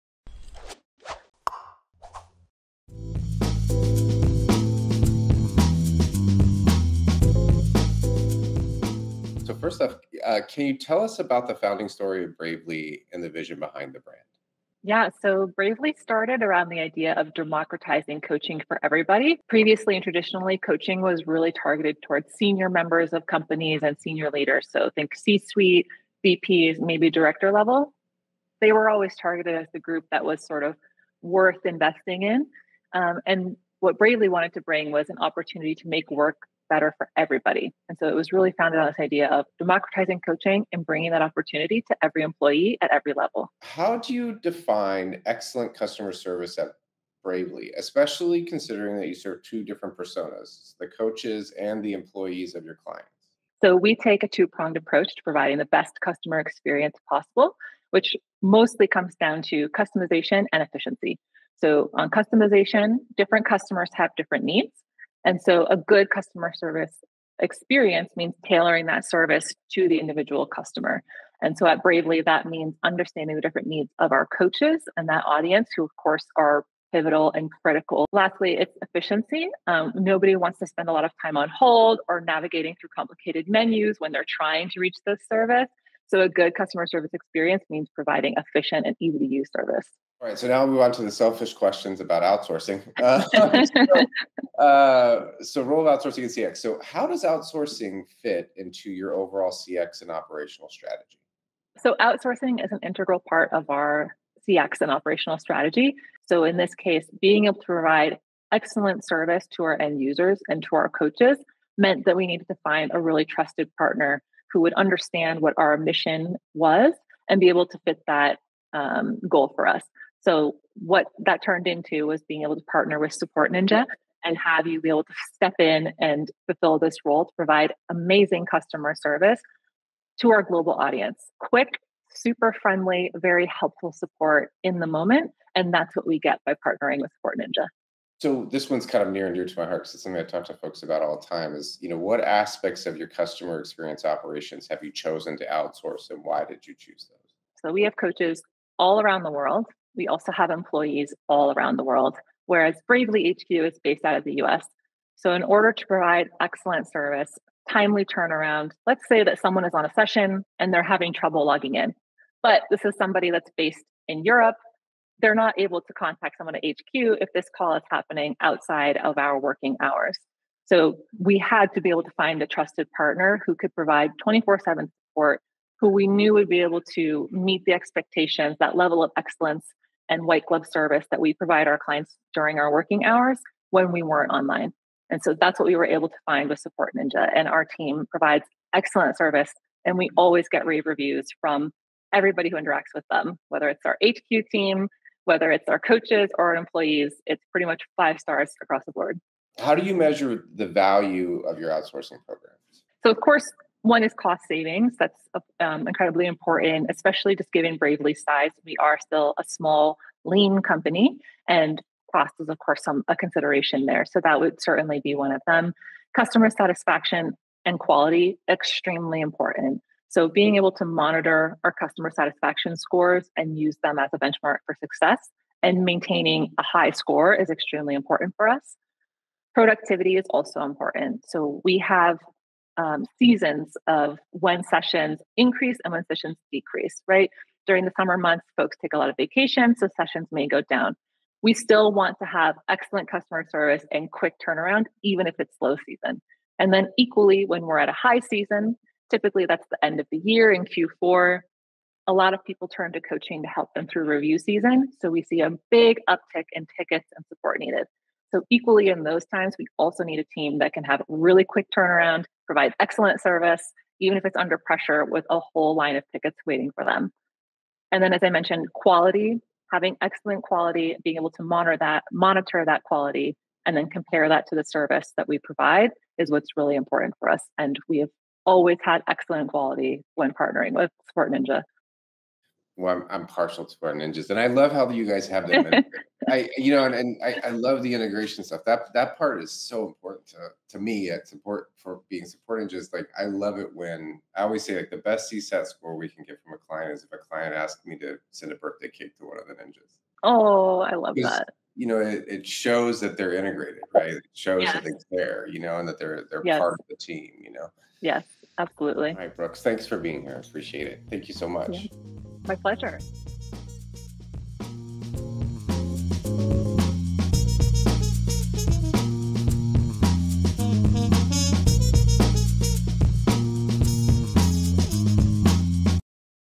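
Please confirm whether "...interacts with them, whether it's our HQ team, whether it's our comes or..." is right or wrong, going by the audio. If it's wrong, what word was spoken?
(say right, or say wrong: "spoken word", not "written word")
wrong: "coaches", not "comes".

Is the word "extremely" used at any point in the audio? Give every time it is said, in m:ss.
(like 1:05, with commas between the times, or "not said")
3:38, 3:47.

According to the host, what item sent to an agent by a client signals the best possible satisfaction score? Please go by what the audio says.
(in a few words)
birthday cake.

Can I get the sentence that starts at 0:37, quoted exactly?
And so it was really founded on this idea of democratizing coaching and bringing that opportunity to every employee at every level.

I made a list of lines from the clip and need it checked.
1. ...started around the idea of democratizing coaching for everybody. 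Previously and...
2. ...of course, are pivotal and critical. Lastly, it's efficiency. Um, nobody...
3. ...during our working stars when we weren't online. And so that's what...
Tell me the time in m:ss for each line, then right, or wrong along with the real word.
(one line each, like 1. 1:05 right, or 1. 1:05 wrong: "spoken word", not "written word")
1. 0:15 right
2. 1:15 right
3. 3:02 wrong: "hours", not "stars".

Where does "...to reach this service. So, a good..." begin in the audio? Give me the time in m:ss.
1:24.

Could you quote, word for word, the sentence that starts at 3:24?
That's uh, um, incredibly important, especially just given Bravely's size.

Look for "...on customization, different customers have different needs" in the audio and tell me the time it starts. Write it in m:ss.
1:01.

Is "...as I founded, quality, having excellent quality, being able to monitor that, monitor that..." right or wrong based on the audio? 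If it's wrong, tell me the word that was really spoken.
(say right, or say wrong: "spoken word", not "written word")
wrong: "mentioned", not "founded".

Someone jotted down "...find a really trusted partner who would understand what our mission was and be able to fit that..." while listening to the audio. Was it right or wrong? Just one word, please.
right.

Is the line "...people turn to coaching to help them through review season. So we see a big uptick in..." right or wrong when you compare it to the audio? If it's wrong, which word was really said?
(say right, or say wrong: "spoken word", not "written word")
right.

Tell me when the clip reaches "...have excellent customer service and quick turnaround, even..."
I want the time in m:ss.
4:02.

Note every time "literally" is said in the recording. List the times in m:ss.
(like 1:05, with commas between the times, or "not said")
not said.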